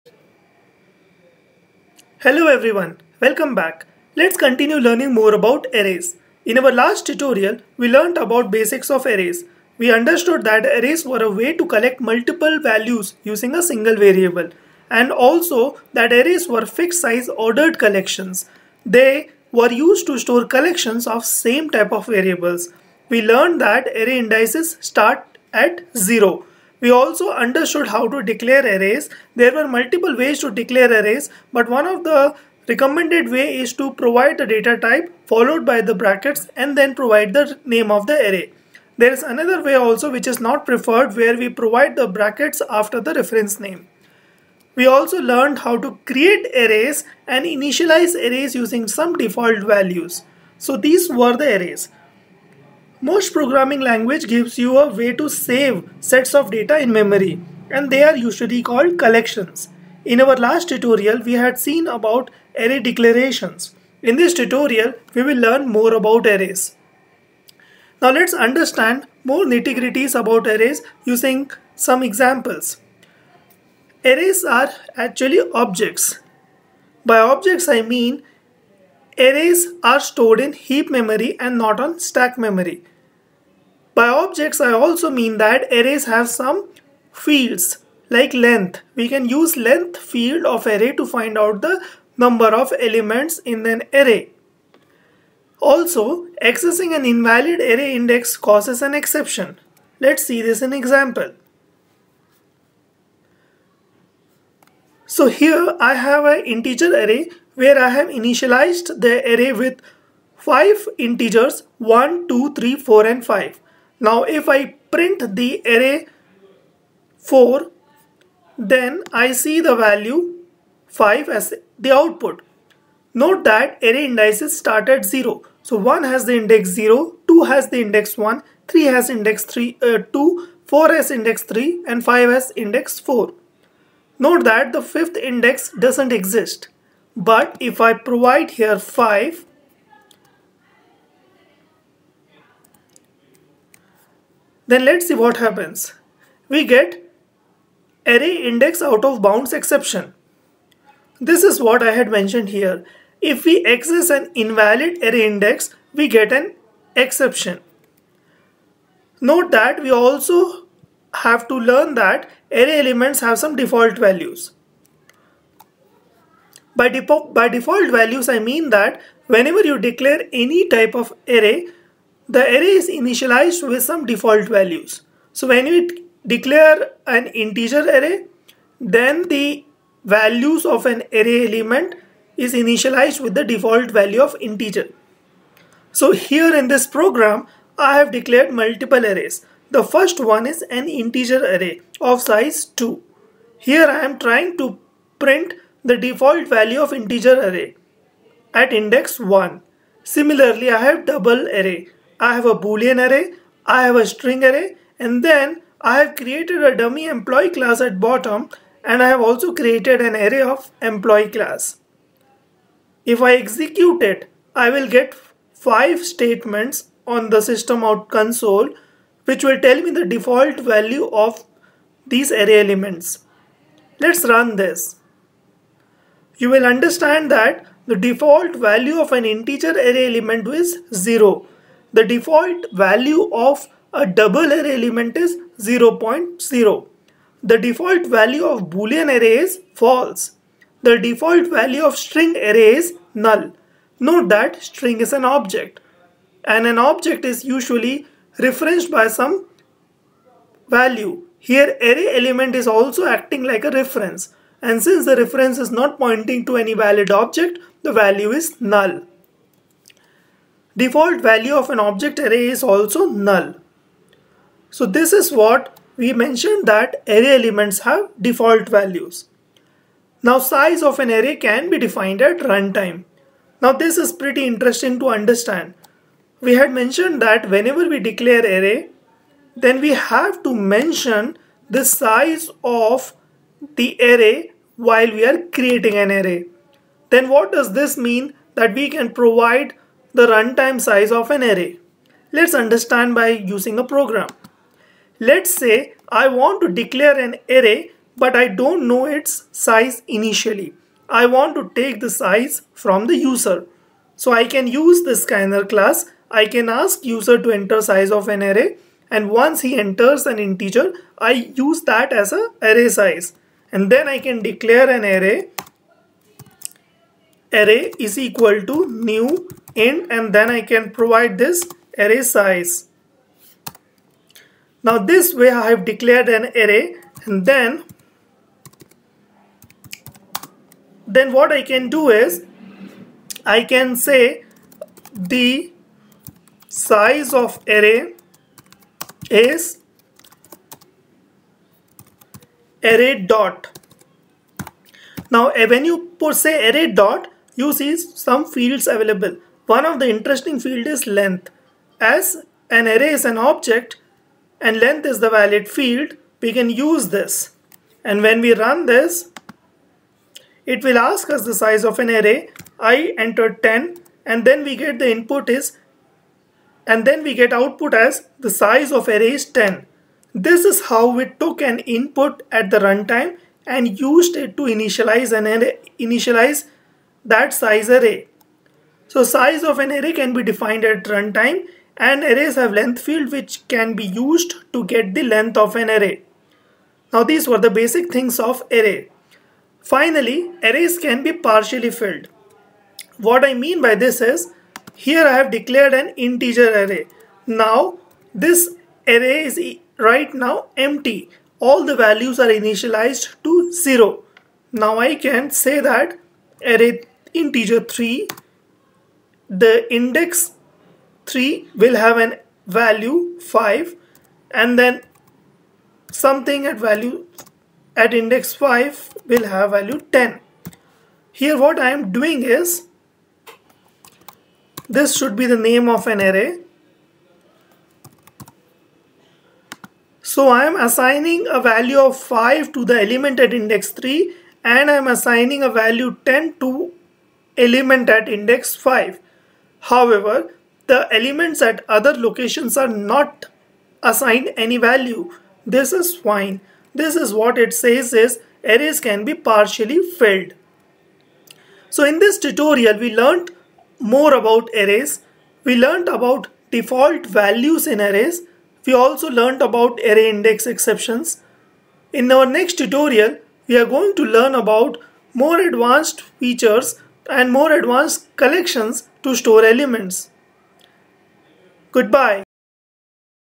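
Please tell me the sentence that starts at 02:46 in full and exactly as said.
By, by default values, I mean that whenever you declare any type of array, the array is initialized with some default values.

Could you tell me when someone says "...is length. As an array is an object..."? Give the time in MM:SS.
05:50.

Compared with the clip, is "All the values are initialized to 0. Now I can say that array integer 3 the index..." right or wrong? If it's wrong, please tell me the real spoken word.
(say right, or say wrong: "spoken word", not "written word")
right.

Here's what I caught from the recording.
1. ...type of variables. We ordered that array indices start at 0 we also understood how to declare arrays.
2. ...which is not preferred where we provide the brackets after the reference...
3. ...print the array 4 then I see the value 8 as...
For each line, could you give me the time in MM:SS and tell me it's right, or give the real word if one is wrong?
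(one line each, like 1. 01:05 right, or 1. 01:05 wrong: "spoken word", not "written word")
1. 00:21 wrong: "learned", not "ordered"
2. 00:40 right
3. 01:54 wrong: "5", not "8".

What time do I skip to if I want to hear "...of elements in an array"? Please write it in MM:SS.
01:32.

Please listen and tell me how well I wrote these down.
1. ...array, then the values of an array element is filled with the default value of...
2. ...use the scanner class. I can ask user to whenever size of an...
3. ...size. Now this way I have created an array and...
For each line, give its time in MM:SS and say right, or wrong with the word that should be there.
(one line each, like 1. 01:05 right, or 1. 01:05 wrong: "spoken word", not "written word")
1. 02:57 wrong: "initialized", not "filled"
2. 05:04 wrong: "enter", not "whenever"
3. 05:22 wrong: "declared", not "created".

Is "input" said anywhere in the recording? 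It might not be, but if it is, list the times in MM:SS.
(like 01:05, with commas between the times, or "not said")
06:05, 06:11.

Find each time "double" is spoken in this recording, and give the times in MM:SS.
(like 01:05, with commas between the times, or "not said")
03:21, 03:54.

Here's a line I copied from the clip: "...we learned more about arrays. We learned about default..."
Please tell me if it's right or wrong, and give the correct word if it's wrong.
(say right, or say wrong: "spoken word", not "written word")
right.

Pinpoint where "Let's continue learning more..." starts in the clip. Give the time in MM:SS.
00:04.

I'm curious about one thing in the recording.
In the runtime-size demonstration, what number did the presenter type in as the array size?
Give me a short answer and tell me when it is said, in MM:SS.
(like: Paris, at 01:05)
10, at 06:02.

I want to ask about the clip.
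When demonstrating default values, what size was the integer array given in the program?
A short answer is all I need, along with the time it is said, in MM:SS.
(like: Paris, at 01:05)
2, at 03:10.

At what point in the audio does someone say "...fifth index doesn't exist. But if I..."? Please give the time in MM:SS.
02:14.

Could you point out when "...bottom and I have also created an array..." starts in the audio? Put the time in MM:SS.
03:27.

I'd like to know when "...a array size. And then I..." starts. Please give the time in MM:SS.
05:12.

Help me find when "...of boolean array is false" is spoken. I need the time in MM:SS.
03:58.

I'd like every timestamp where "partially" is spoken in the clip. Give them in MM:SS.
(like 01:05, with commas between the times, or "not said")
06:31, 07:29.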